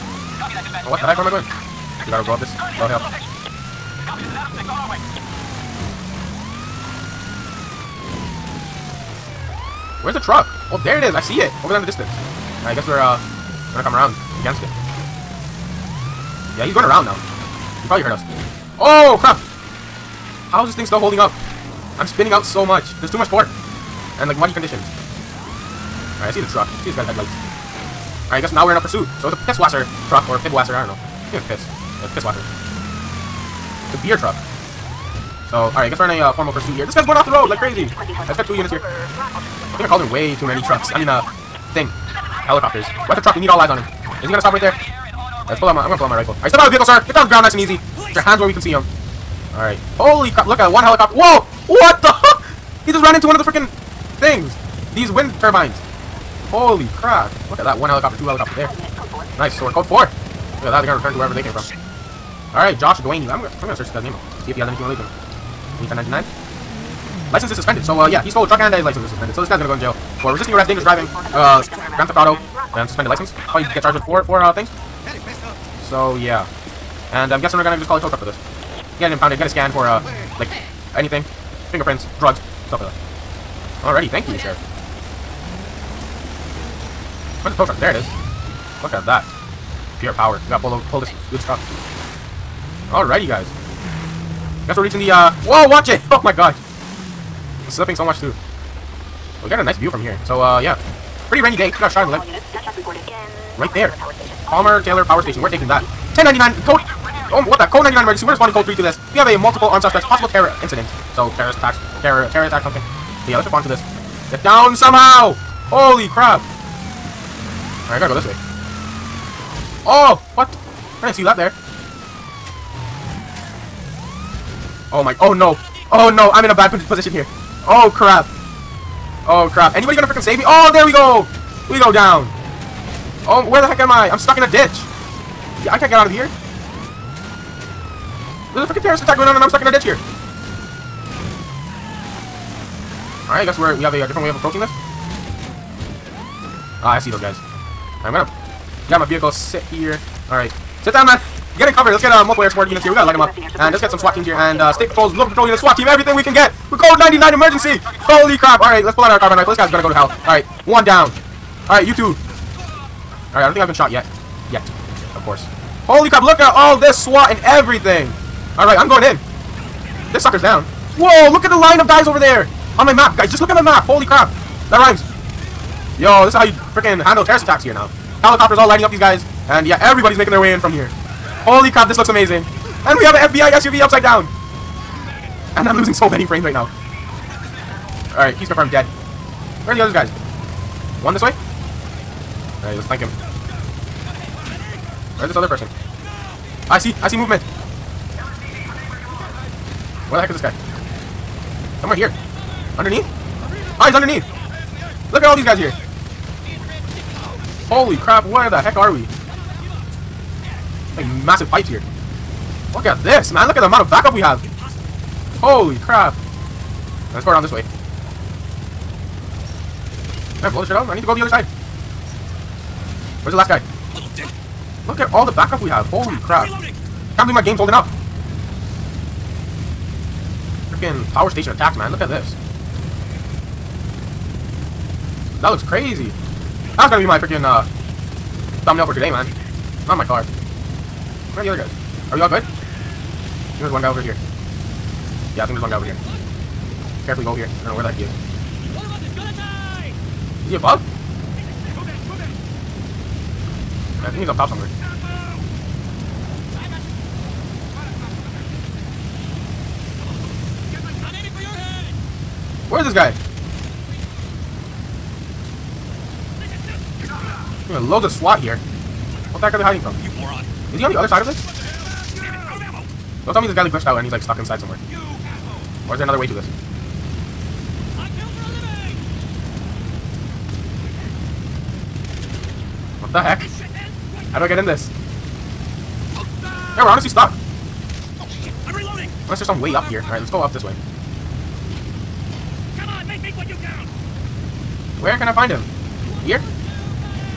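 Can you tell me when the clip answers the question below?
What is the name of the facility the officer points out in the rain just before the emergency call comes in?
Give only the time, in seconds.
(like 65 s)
104 s.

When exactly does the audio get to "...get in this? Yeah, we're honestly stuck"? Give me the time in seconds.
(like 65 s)
284 s.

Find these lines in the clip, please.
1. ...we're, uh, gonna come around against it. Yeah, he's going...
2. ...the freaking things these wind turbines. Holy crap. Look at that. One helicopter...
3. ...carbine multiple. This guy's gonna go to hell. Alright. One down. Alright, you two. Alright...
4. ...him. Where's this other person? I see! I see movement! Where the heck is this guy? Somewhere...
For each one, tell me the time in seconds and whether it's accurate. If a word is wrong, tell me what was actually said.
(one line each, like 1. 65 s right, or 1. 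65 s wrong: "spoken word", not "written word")
1. 12 s right
2. 53 s right
3. 159 s wrong: "rifle", not "multiple"
4. 192 s right.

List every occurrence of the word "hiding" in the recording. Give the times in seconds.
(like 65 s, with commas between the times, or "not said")
269 s.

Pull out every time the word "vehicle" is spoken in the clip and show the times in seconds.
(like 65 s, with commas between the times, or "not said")
46 s, 149 s.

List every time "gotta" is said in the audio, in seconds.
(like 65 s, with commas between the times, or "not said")
2 s, 90 s, 117 s, 152 s.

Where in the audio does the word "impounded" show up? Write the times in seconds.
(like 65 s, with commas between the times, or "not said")
79 s.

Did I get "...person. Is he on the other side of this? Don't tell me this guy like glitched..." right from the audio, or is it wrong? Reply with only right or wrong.
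wrong.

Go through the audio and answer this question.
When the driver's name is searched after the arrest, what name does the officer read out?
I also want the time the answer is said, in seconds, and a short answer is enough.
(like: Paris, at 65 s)
Josh Dwaney, at 62 s.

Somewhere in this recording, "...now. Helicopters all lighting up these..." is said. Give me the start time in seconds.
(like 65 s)
177 s.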